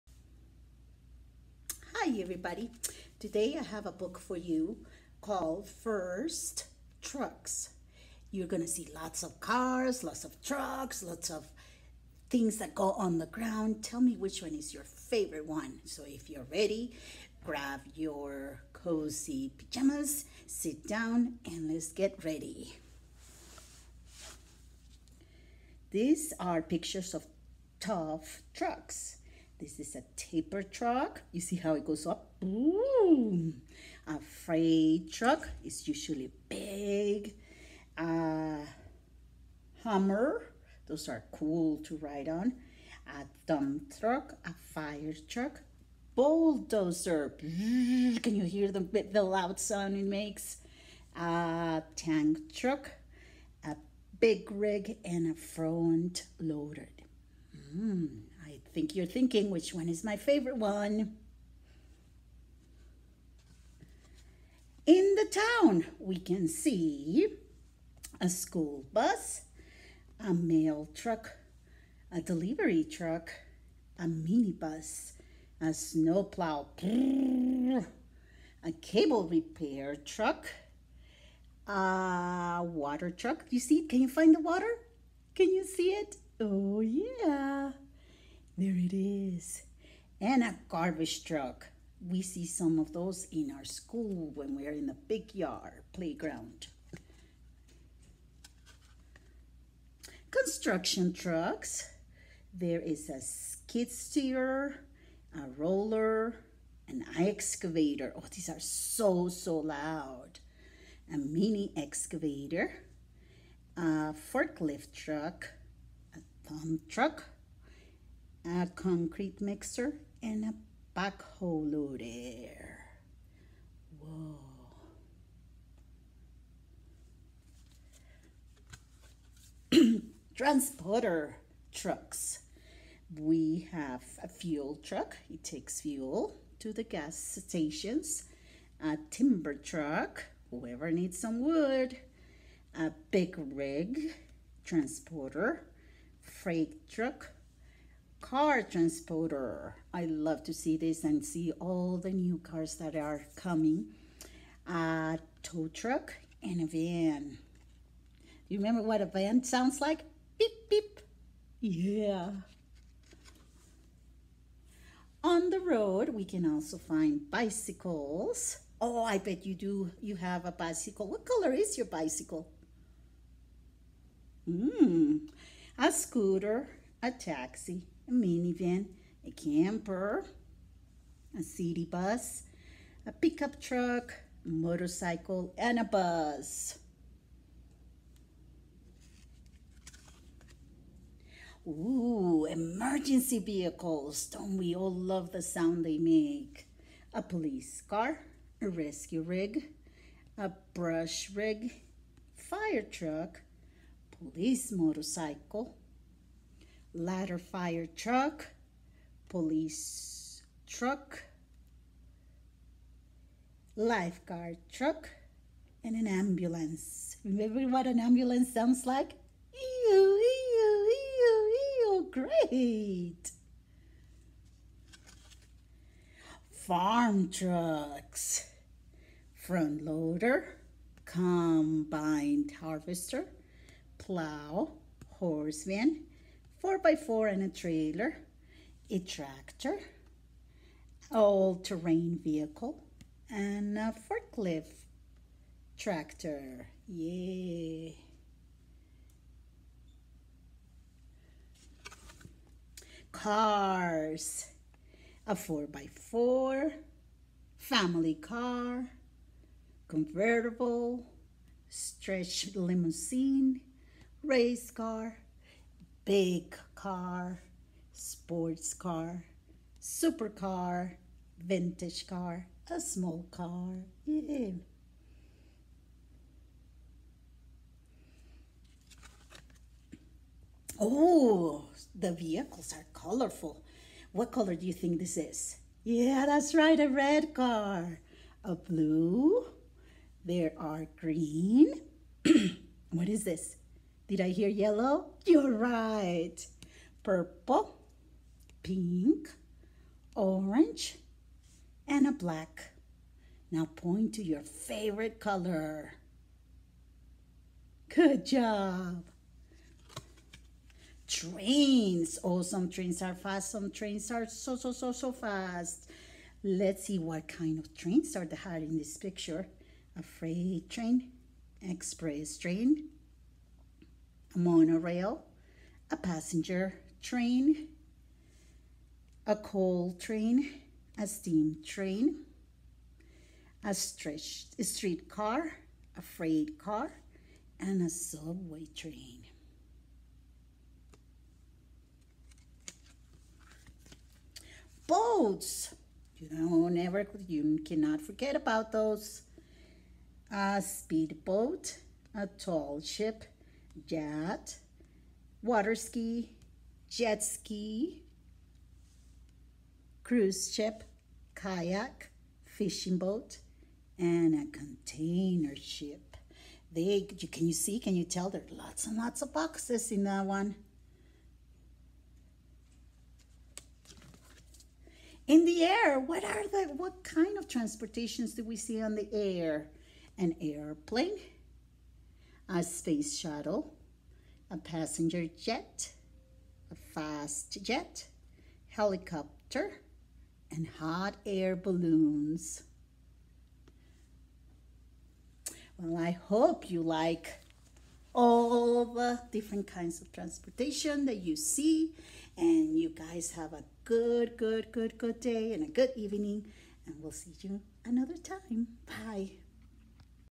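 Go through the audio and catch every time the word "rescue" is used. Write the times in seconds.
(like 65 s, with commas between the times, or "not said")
198 s.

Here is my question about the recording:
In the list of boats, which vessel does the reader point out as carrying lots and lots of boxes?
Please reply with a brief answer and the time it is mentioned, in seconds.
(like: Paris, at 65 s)
container ship, at 364 s.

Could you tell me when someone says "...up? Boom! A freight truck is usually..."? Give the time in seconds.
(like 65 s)
32 s.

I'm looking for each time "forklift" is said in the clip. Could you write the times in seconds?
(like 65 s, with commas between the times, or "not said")
114 s, 244 s.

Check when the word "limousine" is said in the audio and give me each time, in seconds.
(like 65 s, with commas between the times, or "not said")
262 s.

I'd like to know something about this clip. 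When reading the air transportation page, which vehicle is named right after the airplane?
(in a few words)
space shuttle.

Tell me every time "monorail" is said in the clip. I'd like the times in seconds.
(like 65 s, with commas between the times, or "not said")
324 s.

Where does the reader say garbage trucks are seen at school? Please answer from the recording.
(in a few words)
the big yard playground.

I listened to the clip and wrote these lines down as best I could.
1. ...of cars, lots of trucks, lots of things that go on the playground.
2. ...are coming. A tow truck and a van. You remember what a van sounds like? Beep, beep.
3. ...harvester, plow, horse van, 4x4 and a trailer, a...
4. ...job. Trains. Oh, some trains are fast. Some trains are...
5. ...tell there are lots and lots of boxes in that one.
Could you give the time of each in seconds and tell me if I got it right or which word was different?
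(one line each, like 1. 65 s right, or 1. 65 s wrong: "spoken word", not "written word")
1. 9 s wrong: "ground", not "playground"
2. 152 s right
3. 232 s right
4. 308 s right
5. 368 s right.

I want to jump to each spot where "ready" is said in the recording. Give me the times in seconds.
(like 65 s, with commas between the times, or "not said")
16 s, 22 s.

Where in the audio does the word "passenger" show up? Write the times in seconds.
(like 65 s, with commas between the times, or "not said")
325 s, 384 s.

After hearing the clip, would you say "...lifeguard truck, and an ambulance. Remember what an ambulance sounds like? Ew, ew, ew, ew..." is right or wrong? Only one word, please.
right.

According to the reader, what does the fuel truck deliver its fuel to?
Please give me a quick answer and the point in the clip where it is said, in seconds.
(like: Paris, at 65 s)
gas stations, at 136 s.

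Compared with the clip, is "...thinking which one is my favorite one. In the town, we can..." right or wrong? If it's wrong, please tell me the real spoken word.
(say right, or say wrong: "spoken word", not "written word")
right.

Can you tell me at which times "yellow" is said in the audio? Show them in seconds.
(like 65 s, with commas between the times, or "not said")
294 s.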